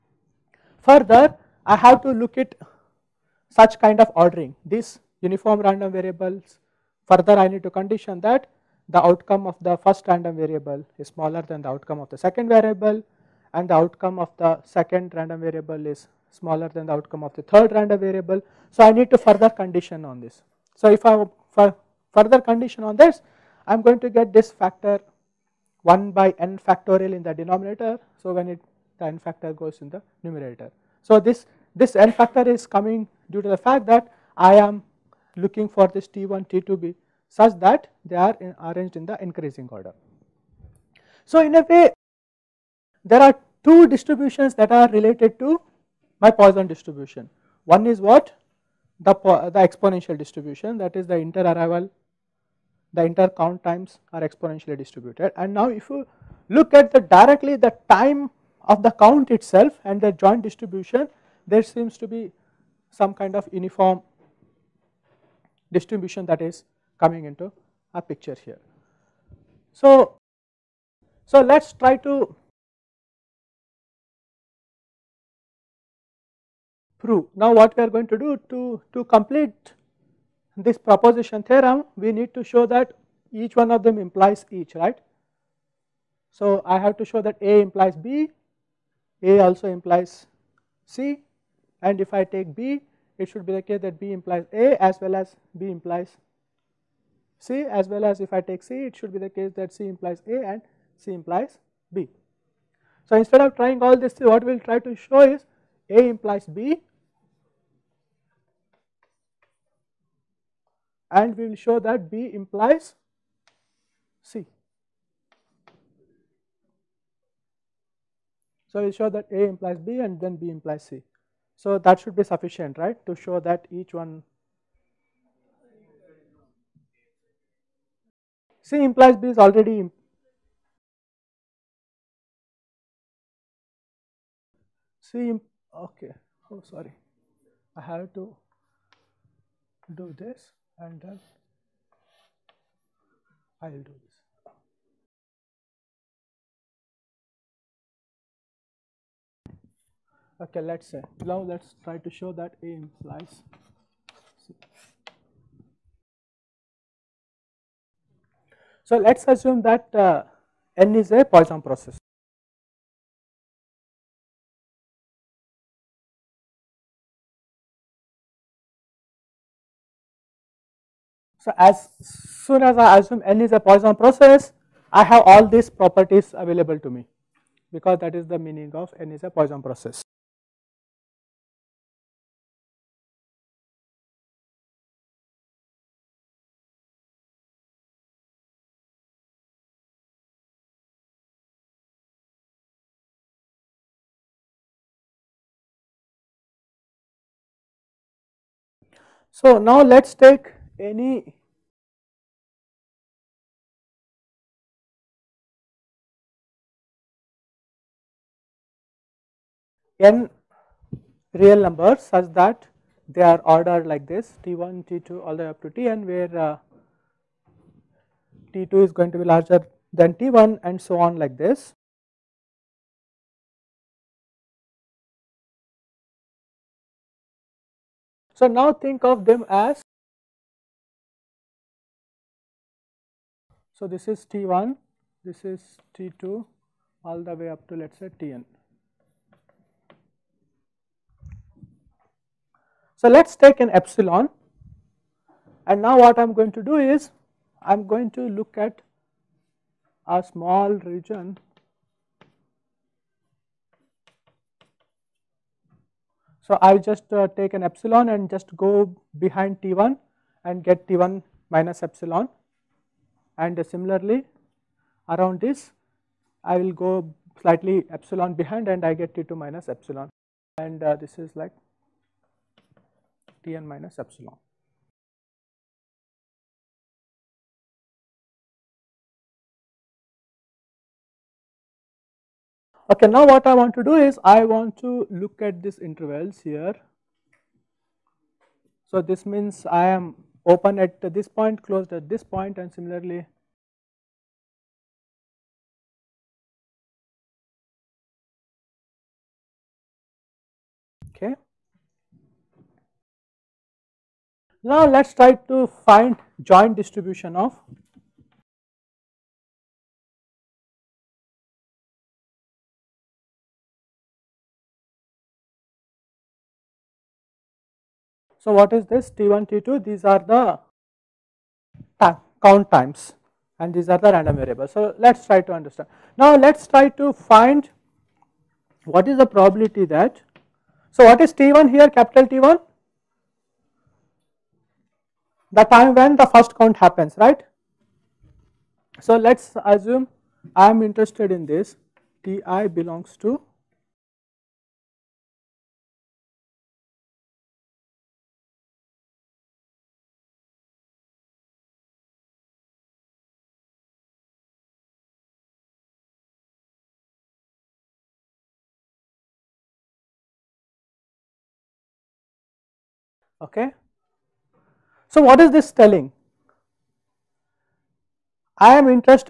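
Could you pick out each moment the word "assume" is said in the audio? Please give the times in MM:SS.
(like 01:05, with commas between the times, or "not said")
02:39, 02:52, 05:39.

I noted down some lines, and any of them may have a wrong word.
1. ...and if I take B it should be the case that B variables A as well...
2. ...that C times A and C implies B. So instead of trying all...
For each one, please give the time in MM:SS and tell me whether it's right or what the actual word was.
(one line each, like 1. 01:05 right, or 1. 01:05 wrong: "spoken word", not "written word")
1. 01:31 wrong: "implies", not "variables"
2. 01:39 wrong: "implies", not "times".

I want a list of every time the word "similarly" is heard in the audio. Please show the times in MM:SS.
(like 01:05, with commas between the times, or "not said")
04:23, 04:52.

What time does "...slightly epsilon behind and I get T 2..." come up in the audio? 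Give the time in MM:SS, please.
04:27.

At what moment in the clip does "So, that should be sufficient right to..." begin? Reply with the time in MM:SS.
02:01.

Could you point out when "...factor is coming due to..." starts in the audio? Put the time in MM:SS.
00:32.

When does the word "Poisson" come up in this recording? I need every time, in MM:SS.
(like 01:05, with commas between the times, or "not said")
00:46, 02:41, 02:53, 02:59.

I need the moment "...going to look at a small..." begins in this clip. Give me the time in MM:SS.
04:07.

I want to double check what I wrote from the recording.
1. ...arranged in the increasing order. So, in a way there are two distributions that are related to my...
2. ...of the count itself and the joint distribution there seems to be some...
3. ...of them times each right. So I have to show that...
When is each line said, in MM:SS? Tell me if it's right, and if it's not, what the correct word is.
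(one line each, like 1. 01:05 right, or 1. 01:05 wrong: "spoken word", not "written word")
1. 00:38 right
2. 00:58 right
3. 01:23 wrong: "implies", not "times".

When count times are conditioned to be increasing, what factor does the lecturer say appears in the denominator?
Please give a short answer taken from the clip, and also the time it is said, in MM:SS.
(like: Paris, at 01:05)
1/n!, at 00:25.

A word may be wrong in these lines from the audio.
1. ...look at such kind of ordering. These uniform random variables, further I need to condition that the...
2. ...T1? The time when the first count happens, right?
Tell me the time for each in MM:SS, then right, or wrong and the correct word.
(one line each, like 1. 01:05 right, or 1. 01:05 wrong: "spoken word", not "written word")
1. 00:02 right
2. 05:32 right.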